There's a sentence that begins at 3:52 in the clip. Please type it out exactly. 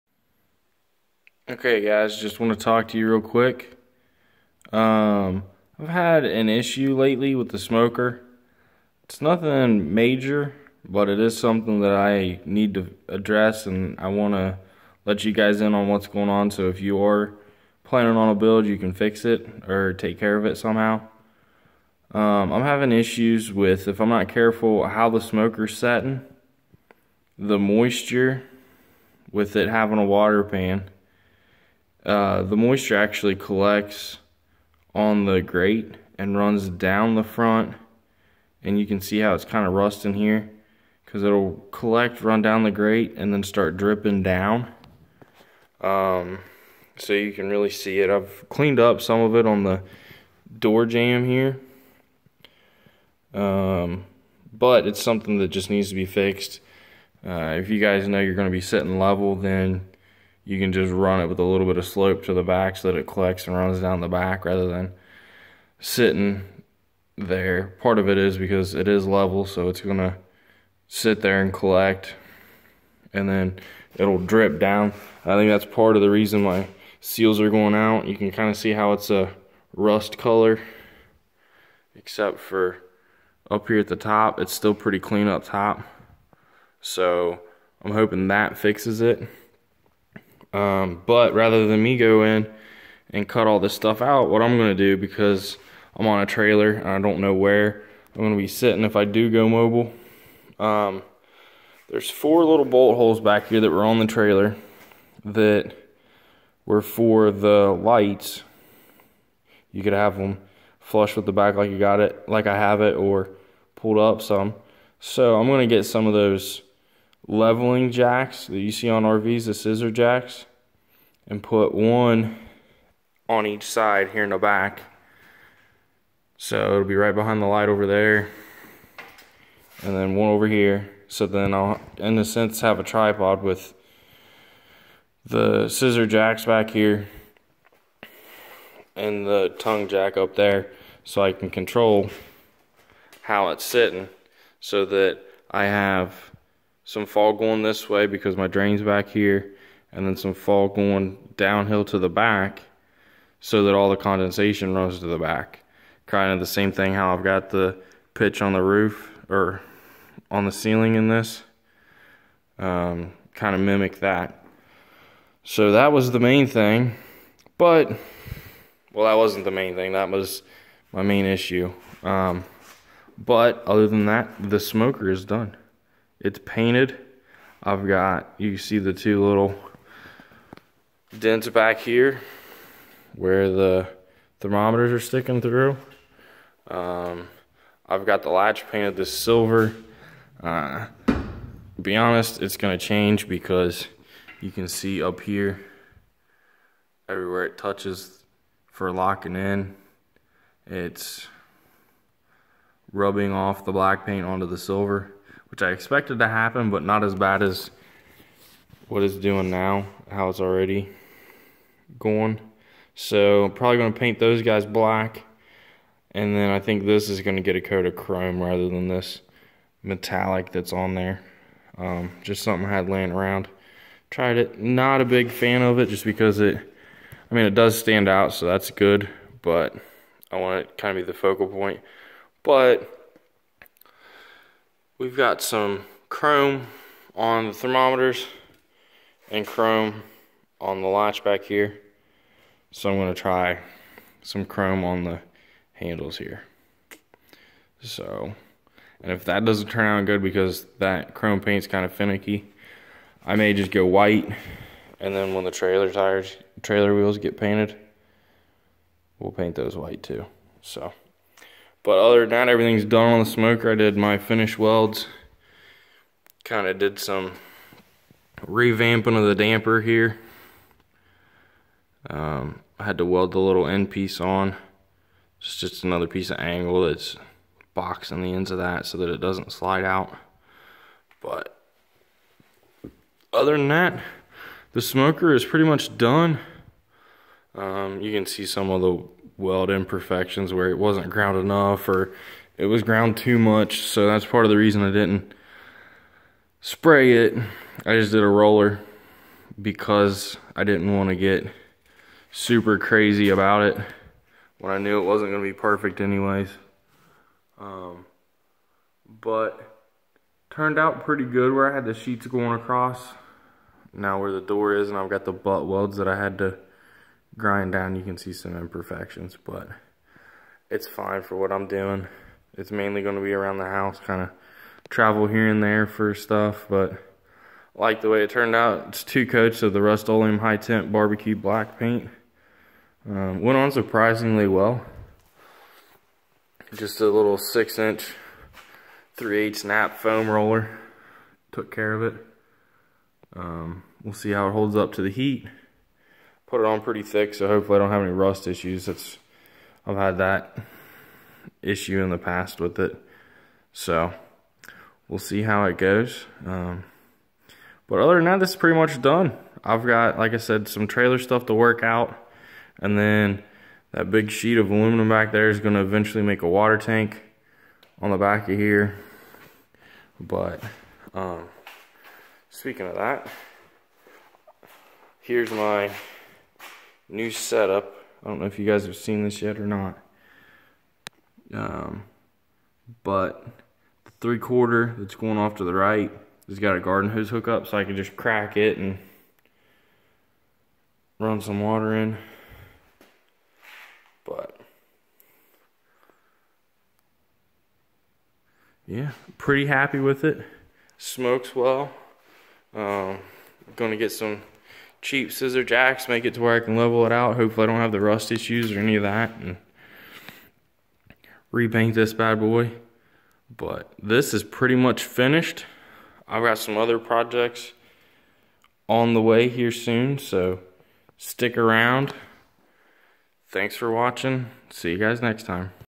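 But We've got some chrome on the thermometers and chrome on the latch back here.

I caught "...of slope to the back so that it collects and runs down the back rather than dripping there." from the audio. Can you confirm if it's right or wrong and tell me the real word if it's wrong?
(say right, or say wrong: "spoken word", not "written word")
wrong: "sitting", not "dripping".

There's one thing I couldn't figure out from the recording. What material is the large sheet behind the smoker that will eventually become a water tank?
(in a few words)
aluminum.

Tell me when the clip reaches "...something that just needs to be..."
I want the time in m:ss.
0:55.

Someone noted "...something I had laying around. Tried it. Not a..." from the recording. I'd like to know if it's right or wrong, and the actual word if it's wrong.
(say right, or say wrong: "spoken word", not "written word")
right.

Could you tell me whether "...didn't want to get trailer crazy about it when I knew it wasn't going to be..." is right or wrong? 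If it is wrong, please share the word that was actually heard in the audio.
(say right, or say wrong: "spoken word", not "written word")
wrong: "super", not "trailer".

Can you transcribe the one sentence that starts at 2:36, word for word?
Kind of the same thing how I've got the pitch on the roof or on the ceiling in this.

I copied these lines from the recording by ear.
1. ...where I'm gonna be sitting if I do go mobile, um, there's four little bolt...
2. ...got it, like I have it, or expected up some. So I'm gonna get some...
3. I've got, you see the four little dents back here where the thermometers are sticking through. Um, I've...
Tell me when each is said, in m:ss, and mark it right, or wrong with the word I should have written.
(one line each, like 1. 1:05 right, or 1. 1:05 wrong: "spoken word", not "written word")
1. 1:37 right
2. 1:51 wrong: "pulled", not "expected"
3. 2:57 wrong: "two", not "four".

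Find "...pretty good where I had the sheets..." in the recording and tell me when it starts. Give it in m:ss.
5:11.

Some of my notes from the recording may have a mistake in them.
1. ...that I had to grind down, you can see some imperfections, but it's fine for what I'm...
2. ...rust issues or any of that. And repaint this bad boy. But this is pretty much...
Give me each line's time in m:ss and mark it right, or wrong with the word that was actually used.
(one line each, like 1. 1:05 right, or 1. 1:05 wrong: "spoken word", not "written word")
1. 5:15 right
2. 6:47 right.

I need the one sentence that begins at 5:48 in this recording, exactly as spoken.
That's I've had that issue in the past with it.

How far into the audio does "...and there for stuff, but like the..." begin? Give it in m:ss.
5:25.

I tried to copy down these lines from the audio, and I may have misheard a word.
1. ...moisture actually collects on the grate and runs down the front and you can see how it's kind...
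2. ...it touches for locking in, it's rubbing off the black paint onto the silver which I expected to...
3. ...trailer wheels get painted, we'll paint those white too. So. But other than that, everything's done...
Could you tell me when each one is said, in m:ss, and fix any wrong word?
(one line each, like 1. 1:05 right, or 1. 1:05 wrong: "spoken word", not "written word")
1. 0:32 right
2. 3:17 right
3. 4:16 right.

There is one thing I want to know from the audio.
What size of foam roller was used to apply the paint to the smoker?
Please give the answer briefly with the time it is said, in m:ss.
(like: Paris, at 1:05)
6-inch, at 5:37.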